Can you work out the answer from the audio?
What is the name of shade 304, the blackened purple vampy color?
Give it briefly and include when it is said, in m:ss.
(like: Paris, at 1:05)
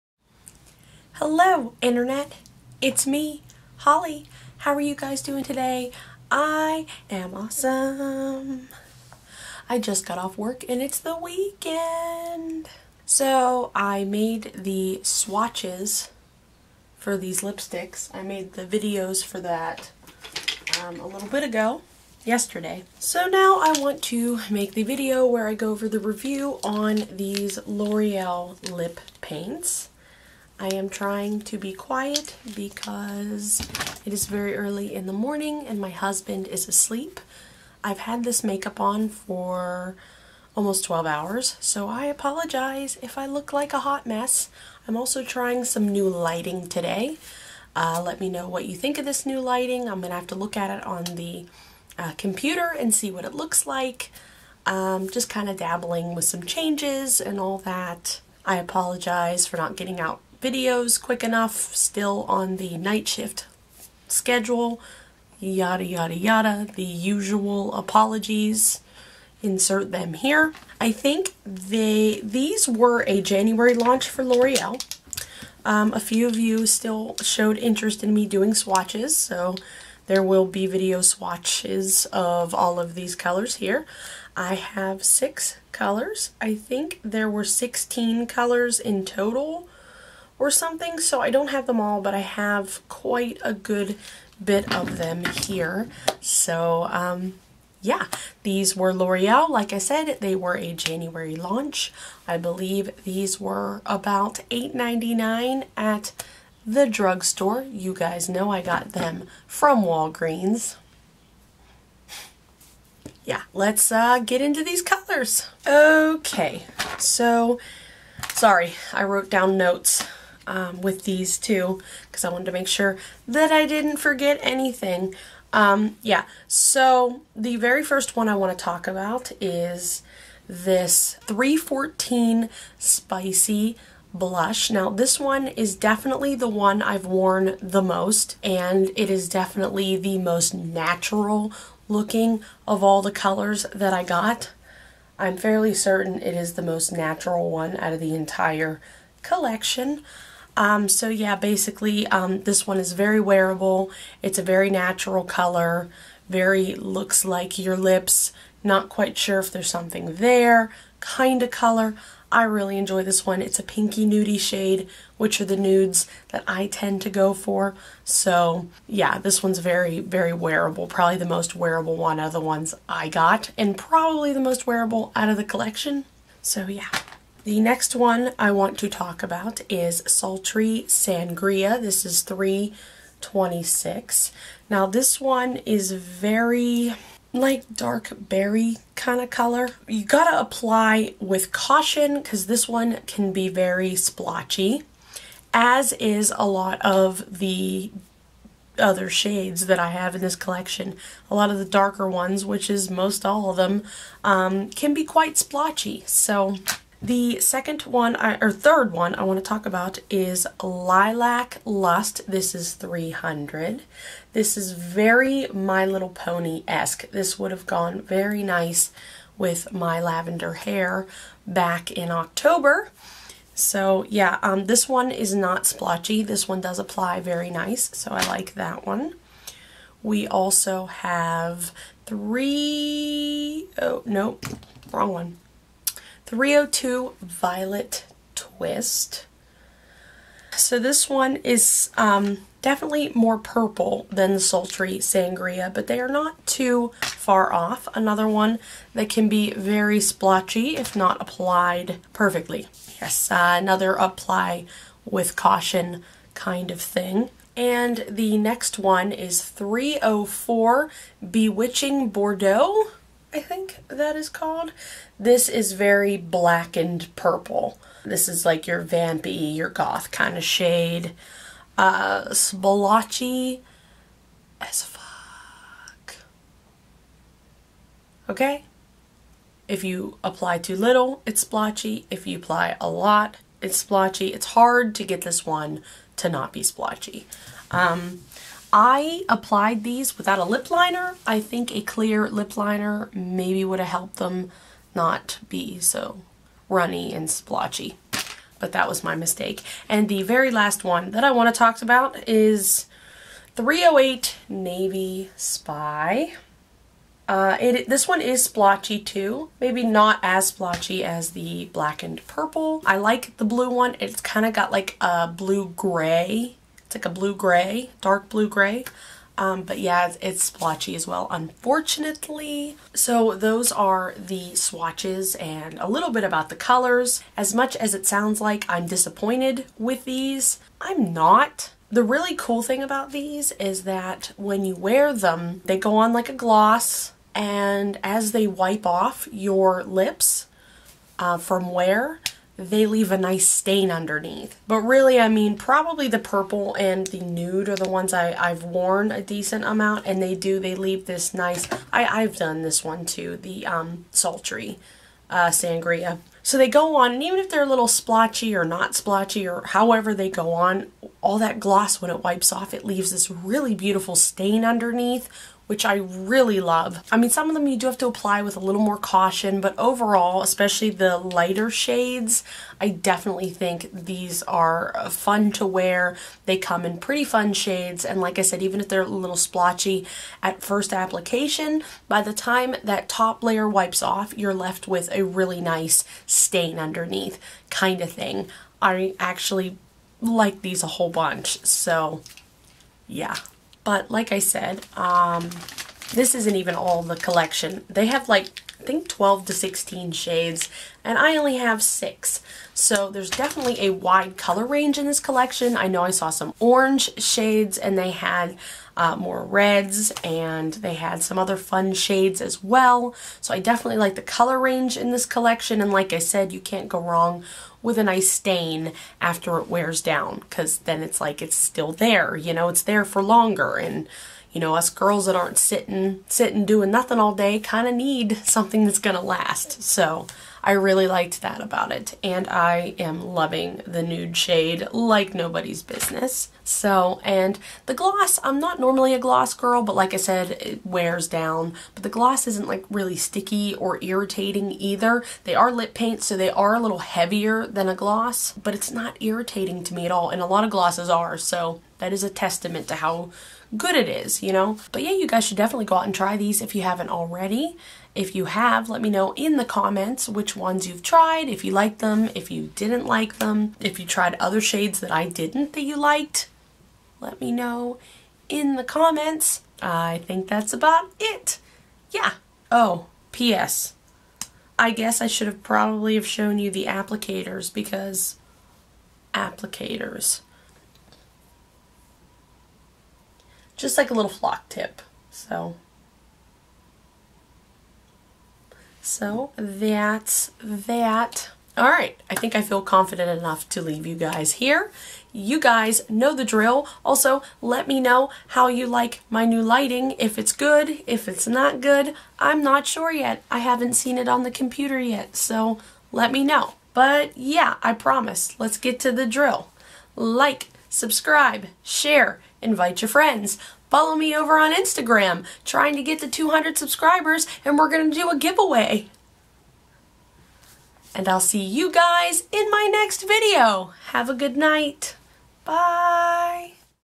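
Bewitching Bordeaux, at 4:21.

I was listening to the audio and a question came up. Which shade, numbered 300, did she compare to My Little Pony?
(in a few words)
Lilac Lust.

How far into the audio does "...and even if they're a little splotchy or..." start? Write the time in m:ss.
5:57.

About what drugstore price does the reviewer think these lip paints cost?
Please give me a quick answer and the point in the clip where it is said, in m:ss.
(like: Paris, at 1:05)
$8.99, at 1:44.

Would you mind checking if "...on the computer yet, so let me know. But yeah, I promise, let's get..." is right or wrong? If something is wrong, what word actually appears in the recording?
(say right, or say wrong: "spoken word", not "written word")
right.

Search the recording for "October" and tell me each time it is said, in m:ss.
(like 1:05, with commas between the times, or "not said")
3:42.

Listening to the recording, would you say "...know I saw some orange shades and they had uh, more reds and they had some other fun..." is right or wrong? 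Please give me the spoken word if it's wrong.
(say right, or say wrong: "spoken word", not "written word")
right.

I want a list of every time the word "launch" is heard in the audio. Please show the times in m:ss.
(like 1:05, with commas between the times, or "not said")
1:13, 1:41.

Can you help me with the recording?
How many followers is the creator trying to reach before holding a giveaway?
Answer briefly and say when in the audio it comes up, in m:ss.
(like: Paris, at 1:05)
200, at 8:36.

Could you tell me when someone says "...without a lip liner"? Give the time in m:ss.
4:50.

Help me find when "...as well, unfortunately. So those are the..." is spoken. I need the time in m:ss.
5:20.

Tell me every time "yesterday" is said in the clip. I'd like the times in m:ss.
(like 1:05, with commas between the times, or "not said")
0:22.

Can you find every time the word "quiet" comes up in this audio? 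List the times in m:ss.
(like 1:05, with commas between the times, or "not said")
0:31.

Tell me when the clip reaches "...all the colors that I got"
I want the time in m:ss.
2:22.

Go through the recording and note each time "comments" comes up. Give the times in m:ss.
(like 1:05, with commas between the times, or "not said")
7:39, 7:48.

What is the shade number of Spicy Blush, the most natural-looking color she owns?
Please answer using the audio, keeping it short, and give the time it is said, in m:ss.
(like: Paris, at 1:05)
314, at 2:11.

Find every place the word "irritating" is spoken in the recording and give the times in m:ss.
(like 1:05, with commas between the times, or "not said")
7:24, 7:29.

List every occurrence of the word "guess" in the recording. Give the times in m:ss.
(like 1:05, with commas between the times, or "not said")
7:54.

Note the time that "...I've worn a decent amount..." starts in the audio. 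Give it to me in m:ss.
5:48.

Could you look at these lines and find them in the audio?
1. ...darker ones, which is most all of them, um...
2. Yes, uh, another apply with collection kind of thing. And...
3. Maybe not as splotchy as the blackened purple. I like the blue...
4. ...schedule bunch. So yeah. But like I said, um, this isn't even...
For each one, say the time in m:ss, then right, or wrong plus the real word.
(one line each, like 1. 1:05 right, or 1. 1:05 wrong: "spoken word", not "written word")
1. 3:21 right
2. 4:13 wrong: "caution", not "collection"
3. 5:09 right
4. 6:30 wrong: "whole", not "schedule".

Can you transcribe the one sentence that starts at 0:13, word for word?
So I made the swatches for these lipsticks.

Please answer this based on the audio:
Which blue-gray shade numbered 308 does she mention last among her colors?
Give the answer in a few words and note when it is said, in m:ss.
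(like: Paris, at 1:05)
Navy Spy, at 5:04.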